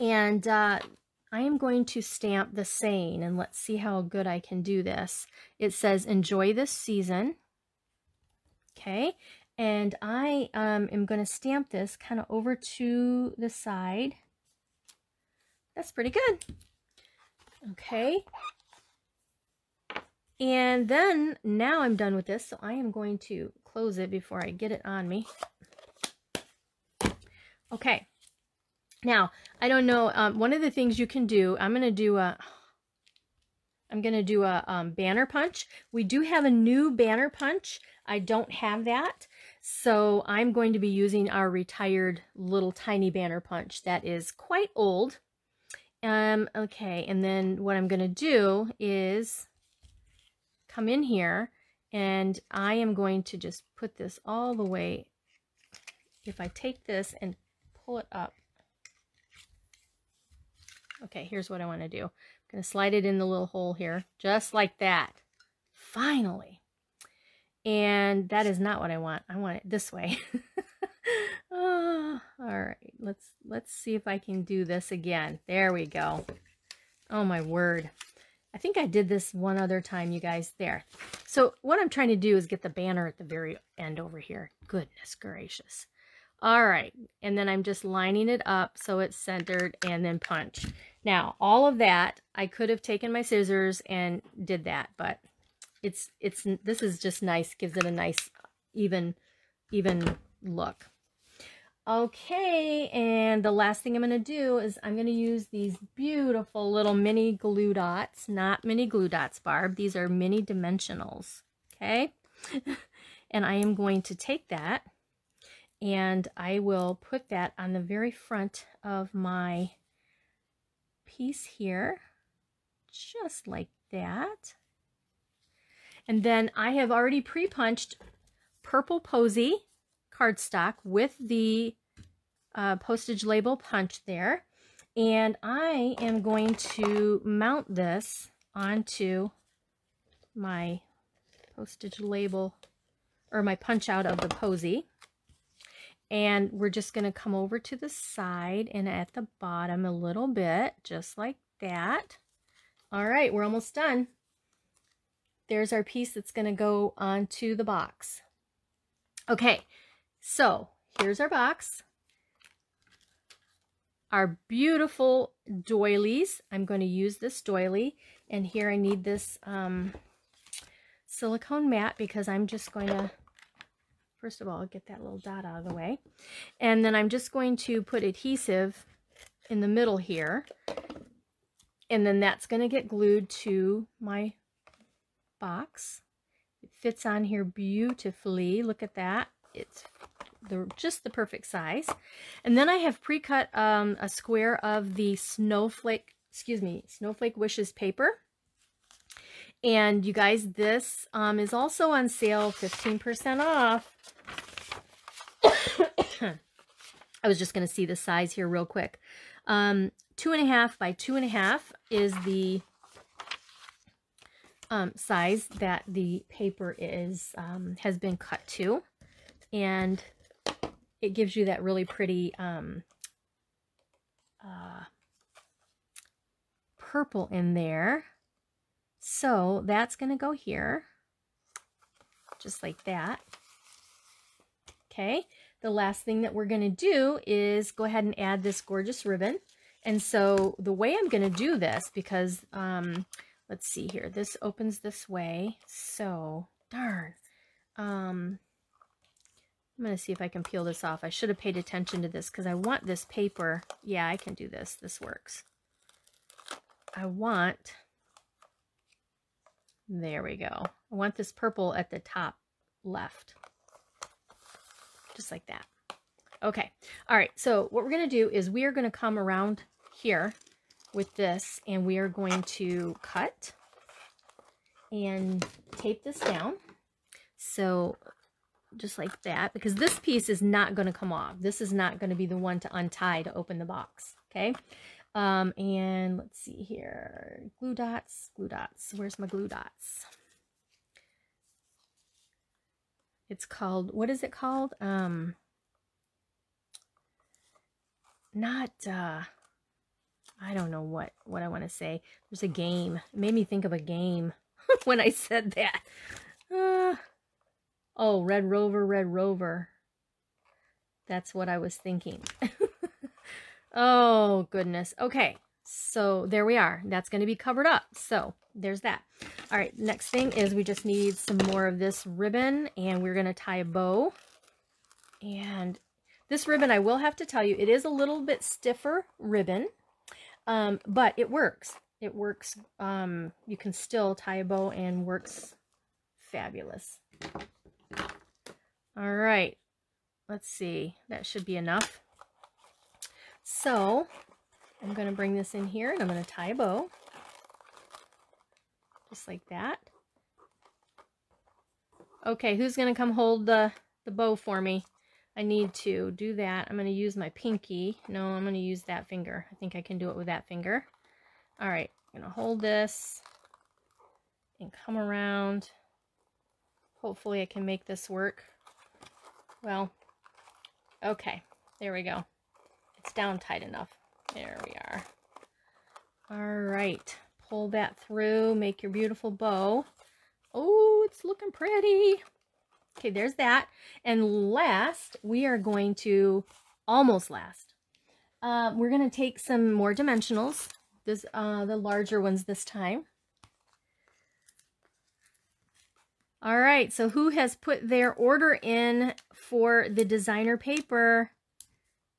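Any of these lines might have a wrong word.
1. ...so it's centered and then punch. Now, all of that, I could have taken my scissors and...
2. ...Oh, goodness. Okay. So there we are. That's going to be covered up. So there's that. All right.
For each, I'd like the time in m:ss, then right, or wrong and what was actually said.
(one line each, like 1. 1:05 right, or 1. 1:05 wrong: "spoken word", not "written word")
1. 1:28 right
2. 5:13 right.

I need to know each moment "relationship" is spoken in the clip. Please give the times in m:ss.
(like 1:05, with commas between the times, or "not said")
not said.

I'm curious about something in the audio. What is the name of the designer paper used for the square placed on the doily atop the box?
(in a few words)
Snowflake wishes.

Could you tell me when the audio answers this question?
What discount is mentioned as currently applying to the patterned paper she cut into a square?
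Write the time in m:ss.
3:22.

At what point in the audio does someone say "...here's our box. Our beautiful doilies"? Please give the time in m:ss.
2:40.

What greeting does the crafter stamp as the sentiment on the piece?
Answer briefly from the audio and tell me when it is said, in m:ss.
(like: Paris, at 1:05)
Enjoy this season, at 0:06.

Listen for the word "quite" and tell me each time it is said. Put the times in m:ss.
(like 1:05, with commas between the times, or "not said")
0:44.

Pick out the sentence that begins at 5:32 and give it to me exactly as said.
Um, you can still tie a bow and works fabulous.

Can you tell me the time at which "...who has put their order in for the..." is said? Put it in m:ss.
6:37.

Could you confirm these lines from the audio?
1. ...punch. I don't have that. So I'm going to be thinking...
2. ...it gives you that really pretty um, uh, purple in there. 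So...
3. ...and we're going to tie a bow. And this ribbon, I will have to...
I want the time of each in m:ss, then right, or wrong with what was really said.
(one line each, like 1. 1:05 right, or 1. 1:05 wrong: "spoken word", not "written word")
1. 0:37 wrong: "using", not "thinking"
2. 3:41 right
3. 5:22 right.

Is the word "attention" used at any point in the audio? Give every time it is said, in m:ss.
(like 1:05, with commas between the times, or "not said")
4:11.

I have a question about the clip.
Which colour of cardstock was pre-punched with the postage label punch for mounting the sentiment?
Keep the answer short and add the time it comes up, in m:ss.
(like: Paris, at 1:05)
Purple posy, at 2:08.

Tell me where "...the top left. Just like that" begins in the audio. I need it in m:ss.
4:21.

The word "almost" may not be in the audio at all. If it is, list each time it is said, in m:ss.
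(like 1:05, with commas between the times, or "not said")
2:33, 6:26.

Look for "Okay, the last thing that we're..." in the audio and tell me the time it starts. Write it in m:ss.
3:54.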